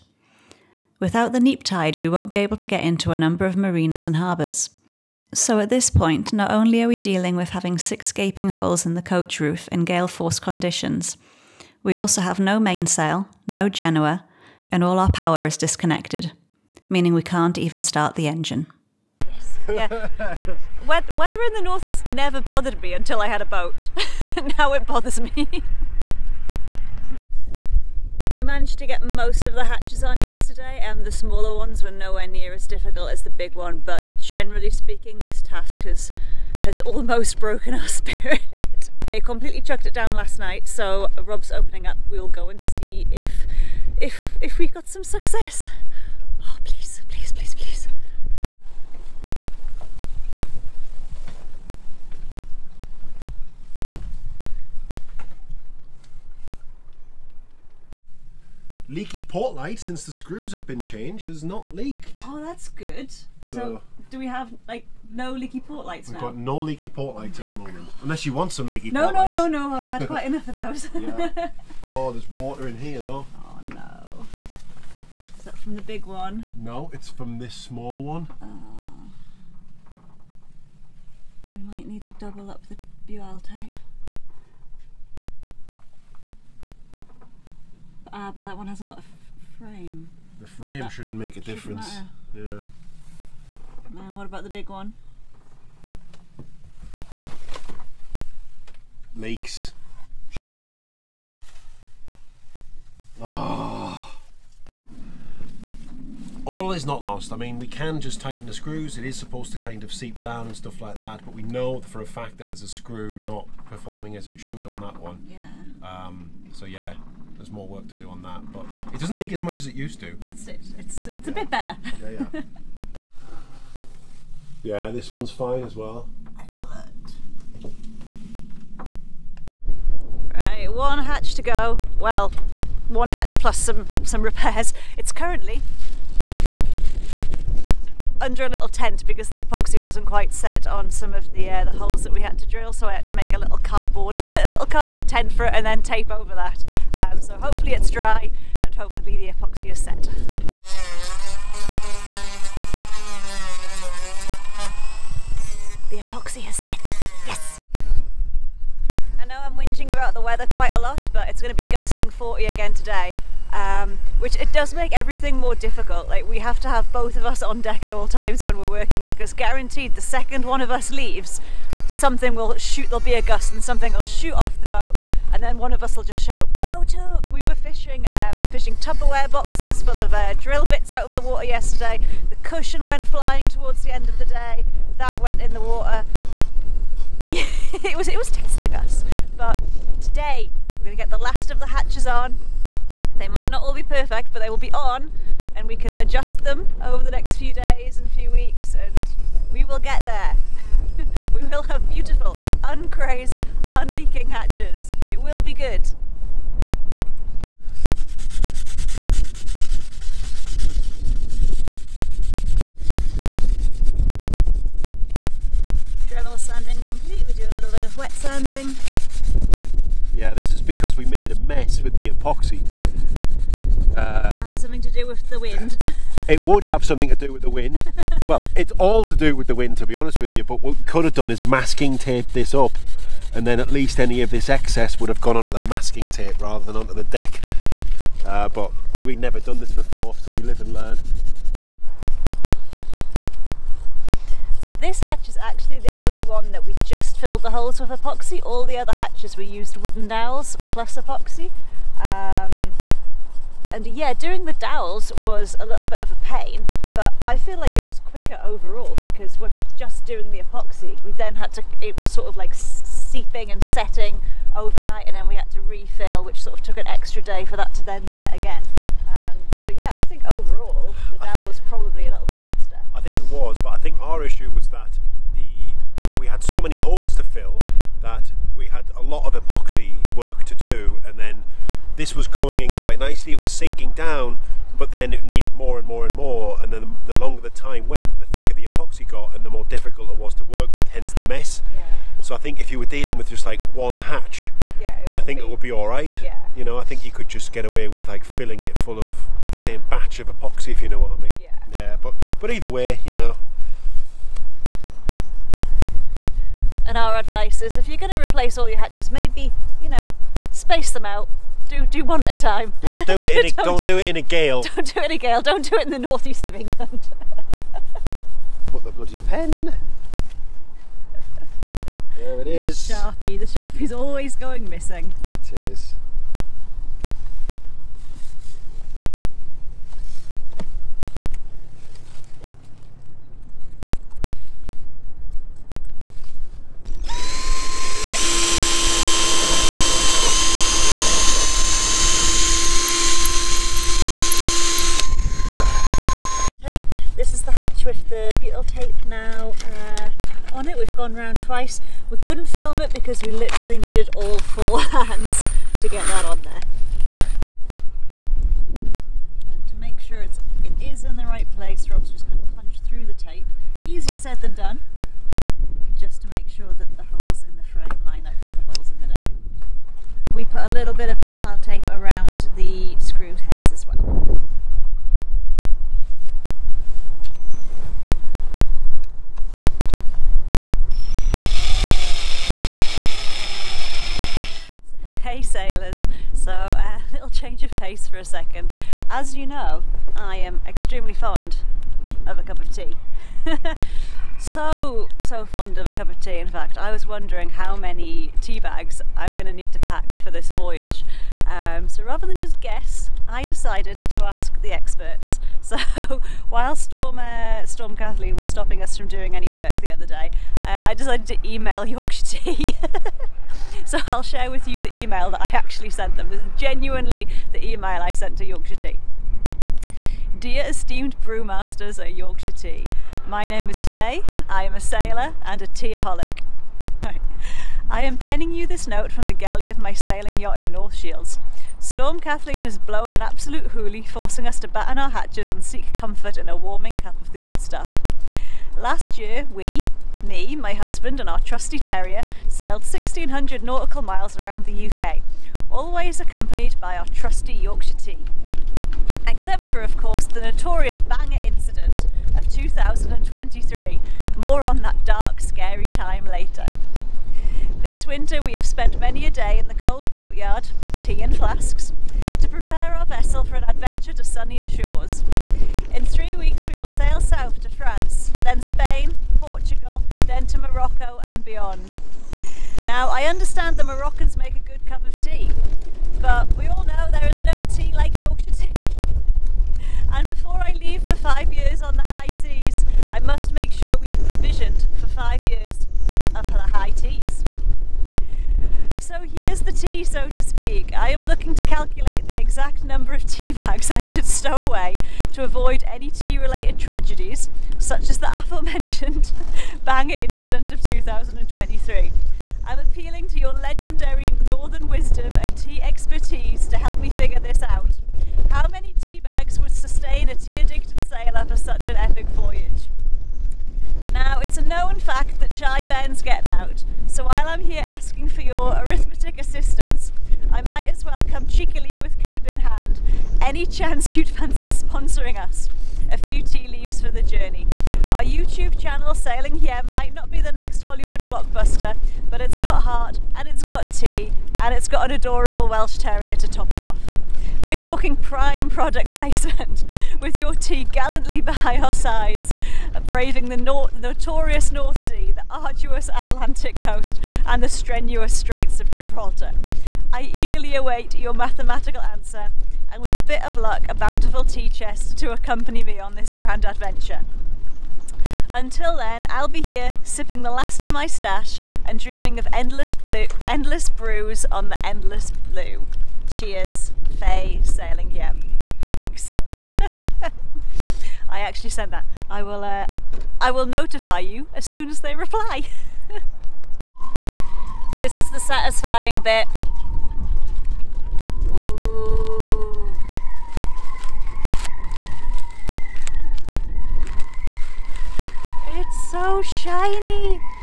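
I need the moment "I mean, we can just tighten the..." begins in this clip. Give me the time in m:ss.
1:47.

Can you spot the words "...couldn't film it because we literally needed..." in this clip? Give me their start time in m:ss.
5:52.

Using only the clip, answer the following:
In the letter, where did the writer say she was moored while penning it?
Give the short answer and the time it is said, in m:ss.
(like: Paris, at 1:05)
North Shields, at 7:10.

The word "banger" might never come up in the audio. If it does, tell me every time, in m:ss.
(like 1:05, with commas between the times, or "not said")
7:30, 8:19.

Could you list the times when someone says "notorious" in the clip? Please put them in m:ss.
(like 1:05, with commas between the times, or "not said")
7:30, 9:03.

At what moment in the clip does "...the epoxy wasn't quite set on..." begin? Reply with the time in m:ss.
2:19.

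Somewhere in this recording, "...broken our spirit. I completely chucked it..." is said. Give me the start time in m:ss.
0:37.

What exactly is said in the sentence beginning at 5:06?
And our advice is, if you're going to replace all your hatches, maybe you know, space them out.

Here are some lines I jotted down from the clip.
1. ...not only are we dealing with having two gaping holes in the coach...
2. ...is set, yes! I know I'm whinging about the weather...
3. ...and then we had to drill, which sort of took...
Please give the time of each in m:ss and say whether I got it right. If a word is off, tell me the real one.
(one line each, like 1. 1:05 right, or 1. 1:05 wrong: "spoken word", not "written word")
1. 0:06 wrong: "six", not "two"
2. 2:36 right
3. 4:25 wrong: "refill", not "drill".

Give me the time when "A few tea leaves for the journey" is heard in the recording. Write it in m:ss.
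8:46.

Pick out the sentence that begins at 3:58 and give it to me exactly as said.
Uh, but we've never done this before, so we live and learn.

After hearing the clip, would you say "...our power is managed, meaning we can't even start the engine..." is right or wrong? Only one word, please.
wrong.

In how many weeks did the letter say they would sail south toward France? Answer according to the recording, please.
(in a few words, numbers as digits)
3.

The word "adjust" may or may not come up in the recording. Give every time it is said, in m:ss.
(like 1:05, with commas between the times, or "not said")
3:15.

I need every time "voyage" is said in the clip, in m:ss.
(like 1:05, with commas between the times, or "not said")
6:40, 8:32.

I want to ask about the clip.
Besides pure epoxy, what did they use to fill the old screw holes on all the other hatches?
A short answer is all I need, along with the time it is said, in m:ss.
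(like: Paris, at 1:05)
wooden dowels, at 4:09.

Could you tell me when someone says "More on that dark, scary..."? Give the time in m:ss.
7:34.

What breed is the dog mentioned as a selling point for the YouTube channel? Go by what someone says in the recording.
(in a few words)
Welsh Terrier.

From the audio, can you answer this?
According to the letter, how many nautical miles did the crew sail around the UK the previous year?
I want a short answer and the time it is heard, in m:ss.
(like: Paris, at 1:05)
1600, at 7:22.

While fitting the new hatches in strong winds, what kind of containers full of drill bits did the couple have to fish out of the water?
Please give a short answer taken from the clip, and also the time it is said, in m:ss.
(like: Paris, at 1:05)
Tupperware boxes, at 2:58.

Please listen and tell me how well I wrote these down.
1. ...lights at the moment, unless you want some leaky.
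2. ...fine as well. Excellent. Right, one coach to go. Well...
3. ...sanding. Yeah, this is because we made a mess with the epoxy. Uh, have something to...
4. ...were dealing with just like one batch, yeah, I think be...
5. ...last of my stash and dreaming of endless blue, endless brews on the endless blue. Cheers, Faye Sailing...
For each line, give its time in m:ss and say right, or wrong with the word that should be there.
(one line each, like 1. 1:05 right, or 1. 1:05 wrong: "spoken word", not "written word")
1. 1:07 right
2. 2:05 wrong: "hatch", not "coach"
3. 3:38 right
4. 4:52 wrong: "hatch", not "batch"
5. 9:20 right.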